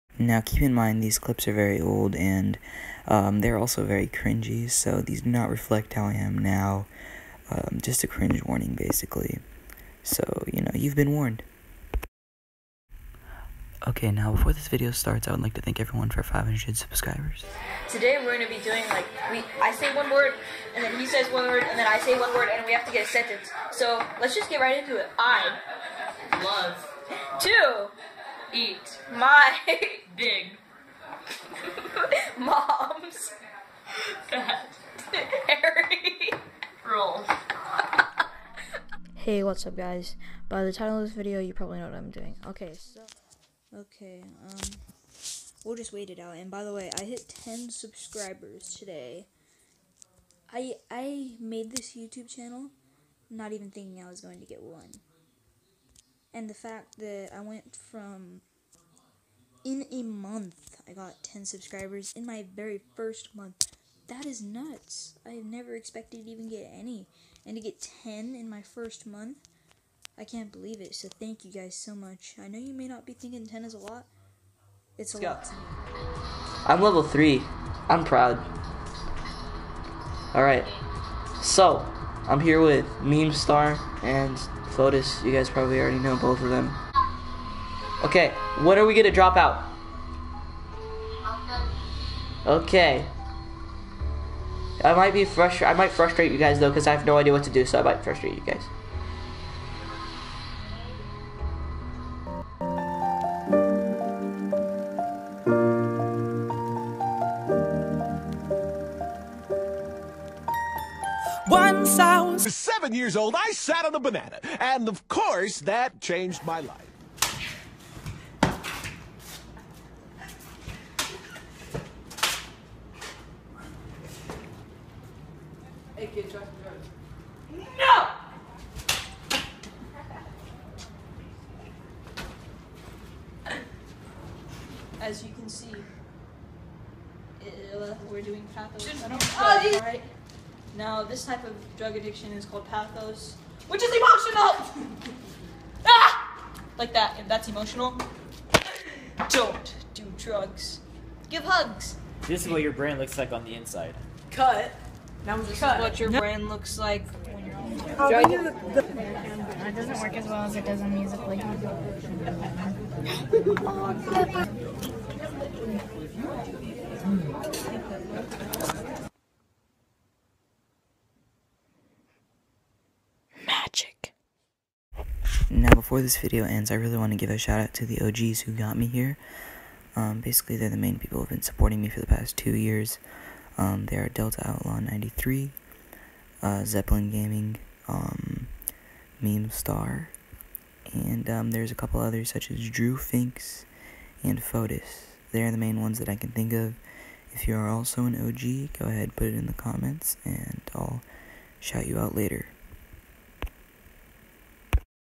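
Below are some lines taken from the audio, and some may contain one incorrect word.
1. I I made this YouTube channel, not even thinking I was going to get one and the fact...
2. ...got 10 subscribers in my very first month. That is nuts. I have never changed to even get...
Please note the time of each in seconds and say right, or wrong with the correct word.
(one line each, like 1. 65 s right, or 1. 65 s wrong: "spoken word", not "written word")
1. 50 s right
2. 60 s wrong: "expected", not "changed".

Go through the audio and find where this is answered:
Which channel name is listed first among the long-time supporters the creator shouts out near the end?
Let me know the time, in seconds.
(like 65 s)
184 s.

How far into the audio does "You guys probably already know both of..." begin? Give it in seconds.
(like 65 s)
85 s.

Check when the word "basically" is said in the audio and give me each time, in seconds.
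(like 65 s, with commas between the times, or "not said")
8 s, 180 s.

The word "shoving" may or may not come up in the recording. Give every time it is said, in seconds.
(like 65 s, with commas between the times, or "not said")
not said.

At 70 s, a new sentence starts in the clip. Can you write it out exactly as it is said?
So thank you guys so much.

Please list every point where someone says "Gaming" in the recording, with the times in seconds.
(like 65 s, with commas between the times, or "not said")
187 s.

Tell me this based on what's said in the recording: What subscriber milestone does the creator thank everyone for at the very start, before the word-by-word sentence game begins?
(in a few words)
500.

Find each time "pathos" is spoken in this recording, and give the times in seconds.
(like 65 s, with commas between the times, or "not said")
138 s, 142 s.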